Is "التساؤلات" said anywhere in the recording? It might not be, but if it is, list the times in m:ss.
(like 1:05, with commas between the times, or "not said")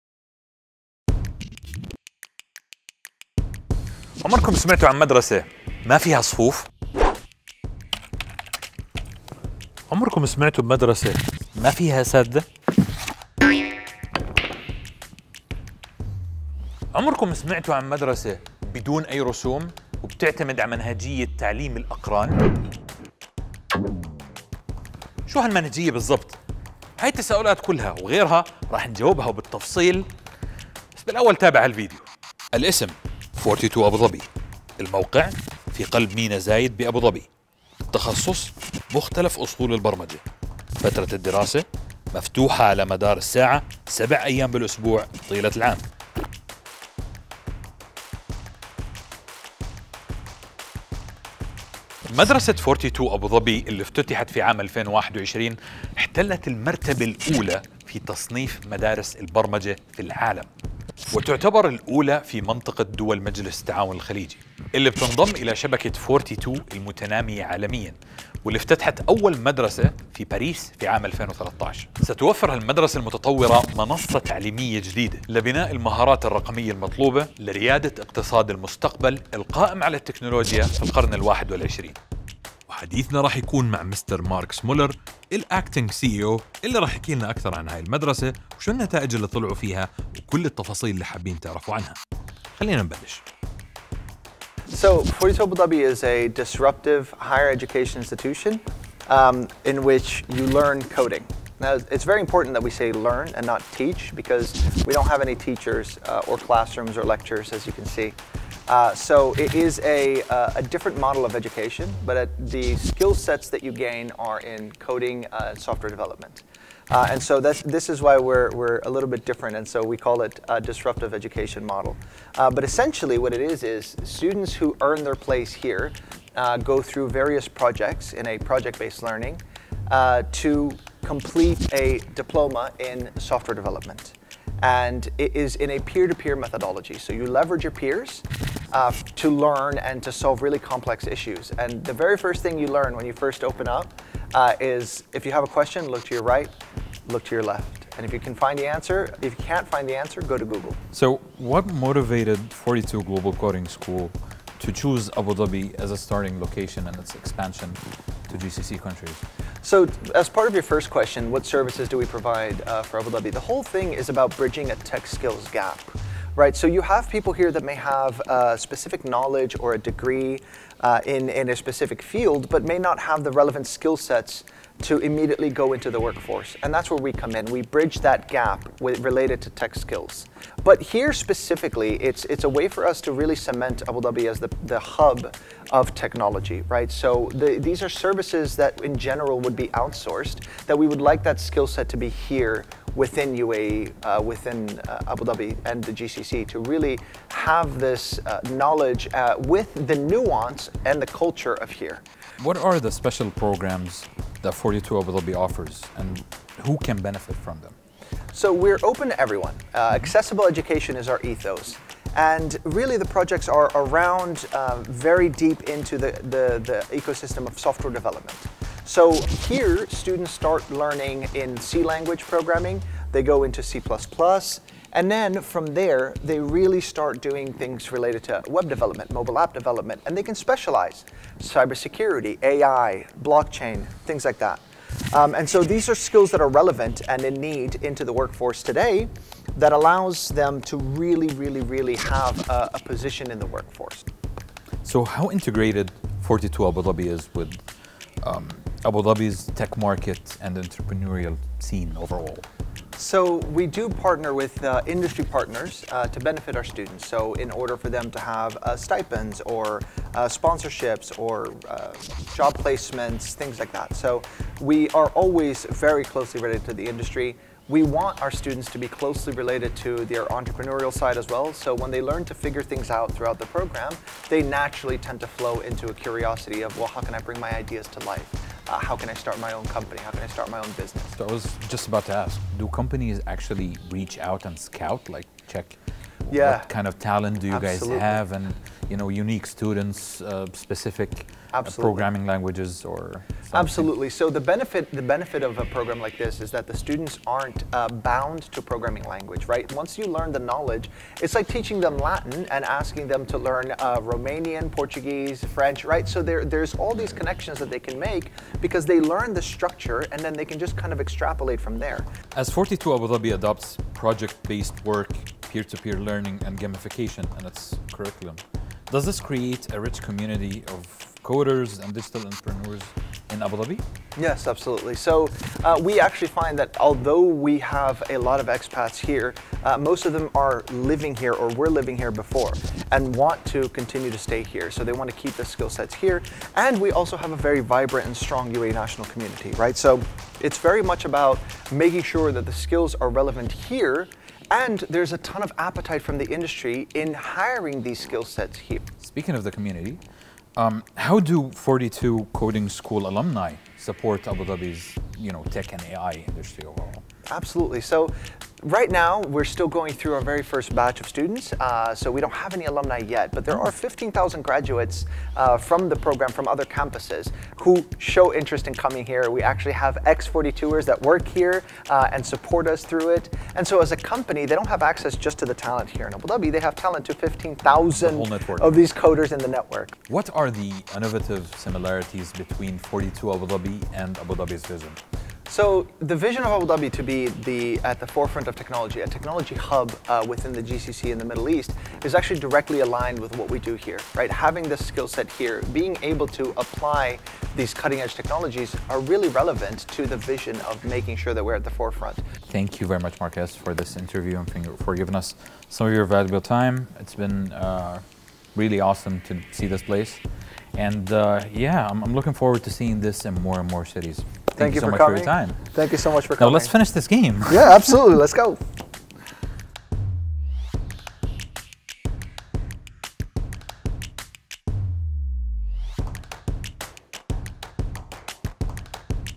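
0:27.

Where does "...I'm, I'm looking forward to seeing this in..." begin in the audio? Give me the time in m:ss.
6:51.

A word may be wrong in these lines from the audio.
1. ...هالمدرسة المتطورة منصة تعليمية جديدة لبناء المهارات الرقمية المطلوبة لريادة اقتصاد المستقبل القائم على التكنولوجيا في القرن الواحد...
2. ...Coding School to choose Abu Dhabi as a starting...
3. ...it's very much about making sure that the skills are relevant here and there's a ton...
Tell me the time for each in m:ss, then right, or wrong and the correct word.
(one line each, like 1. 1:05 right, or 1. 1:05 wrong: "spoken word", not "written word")
1. 1:12 right
2. 2:33 right
3. 5:40 right.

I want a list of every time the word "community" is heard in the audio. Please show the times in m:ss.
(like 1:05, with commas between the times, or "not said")
5:20, 5:39, 5:49.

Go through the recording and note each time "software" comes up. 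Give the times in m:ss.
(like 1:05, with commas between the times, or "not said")
1:55, 2:13, 3:37.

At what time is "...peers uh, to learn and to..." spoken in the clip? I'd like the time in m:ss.
2:17.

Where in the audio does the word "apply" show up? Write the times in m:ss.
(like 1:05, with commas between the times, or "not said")
6:36.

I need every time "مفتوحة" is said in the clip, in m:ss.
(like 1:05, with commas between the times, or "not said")
0:42.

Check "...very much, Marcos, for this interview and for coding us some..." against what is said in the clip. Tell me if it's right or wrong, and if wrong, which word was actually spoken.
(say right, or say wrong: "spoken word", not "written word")
wrong: "giving", not "coding".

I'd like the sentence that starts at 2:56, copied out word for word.
And that's where we come in.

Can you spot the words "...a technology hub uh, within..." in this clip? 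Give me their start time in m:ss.
6:29.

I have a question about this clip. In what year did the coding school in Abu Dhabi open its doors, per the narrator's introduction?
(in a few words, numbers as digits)
2021.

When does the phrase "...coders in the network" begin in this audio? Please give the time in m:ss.
6:18.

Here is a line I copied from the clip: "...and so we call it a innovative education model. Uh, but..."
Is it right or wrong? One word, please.
wrong.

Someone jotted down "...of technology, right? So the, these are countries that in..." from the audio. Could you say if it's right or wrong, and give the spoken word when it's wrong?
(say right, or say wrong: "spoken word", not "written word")
wrong: "services", not "countries".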